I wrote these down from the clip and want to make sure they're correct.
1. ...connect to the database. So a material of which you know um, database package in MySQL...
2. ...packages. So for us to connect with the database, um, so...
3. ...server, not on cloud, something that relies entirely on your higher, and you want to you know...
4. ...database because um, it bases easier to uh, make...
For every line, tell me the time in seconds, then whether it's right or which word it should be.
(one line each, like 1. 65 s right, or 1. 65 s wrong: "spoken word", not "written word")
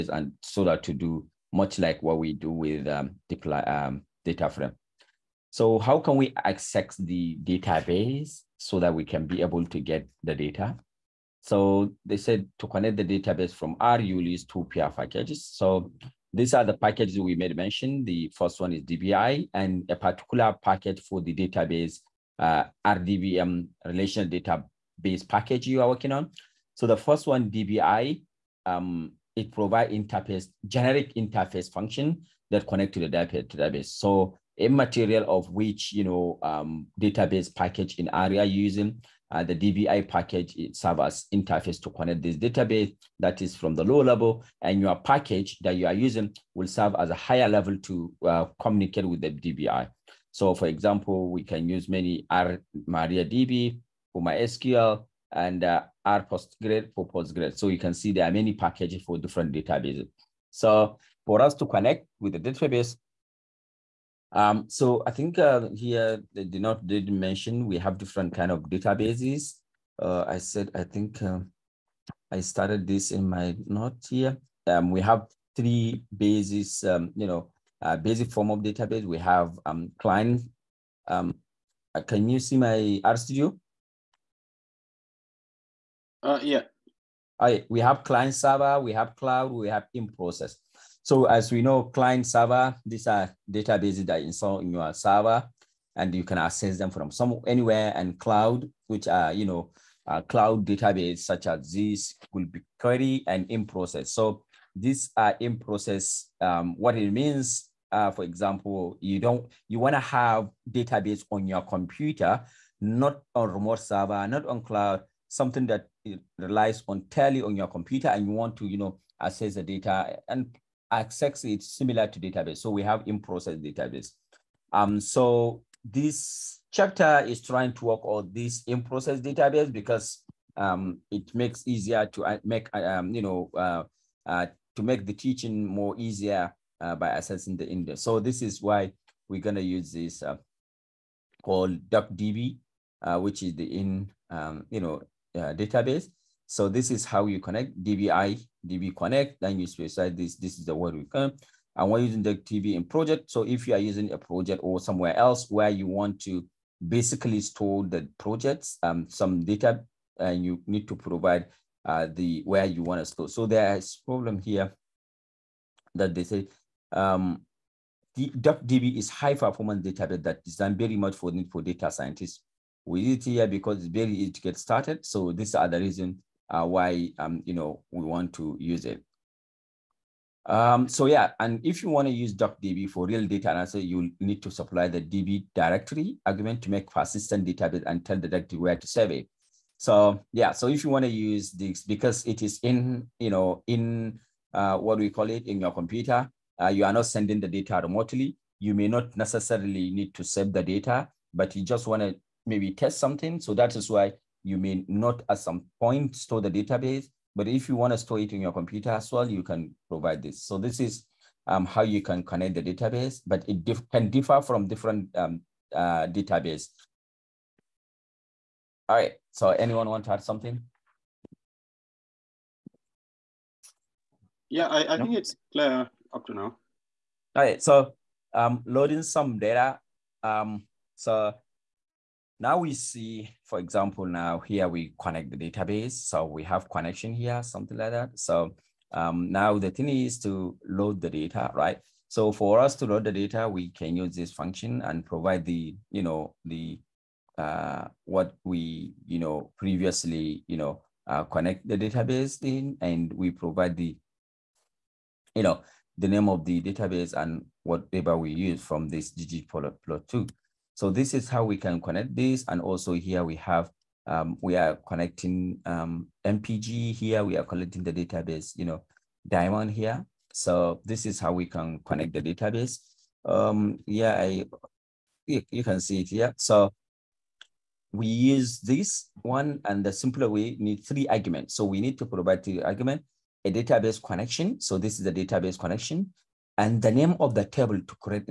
1. 32 s wrong: "ARIA", not "MySQL"
2. 59 s wrong: "databases", not "packages"
3. 113 s wrong: "computer", not "higher"
4. 129 s wrong: "makes", not "bases".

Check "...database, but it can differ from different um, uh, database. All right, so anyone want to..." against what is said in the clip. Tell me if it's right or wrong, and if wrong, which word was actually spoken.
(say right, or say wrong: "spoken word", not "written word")
right.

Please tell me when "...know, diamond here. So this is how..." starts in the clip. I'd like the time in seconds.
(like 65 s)
268 s.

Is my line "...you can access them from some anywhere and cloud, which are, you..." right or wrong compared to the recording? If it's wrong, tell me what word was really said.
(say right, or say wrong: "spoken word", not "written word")
right.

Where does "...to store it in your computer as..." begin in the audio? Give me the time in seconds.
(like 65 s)
207 s.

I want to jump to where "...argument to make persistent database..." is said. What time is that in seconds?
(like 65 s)
186 s.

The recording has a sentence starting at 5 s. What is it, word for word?
So how can we access the database?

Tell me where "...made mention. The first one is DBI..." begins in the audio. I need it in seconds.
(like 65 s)
17 s.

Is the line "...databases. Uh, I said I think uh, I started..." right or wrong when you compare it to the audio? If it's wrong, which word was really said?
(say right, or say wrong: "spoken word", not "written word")
right.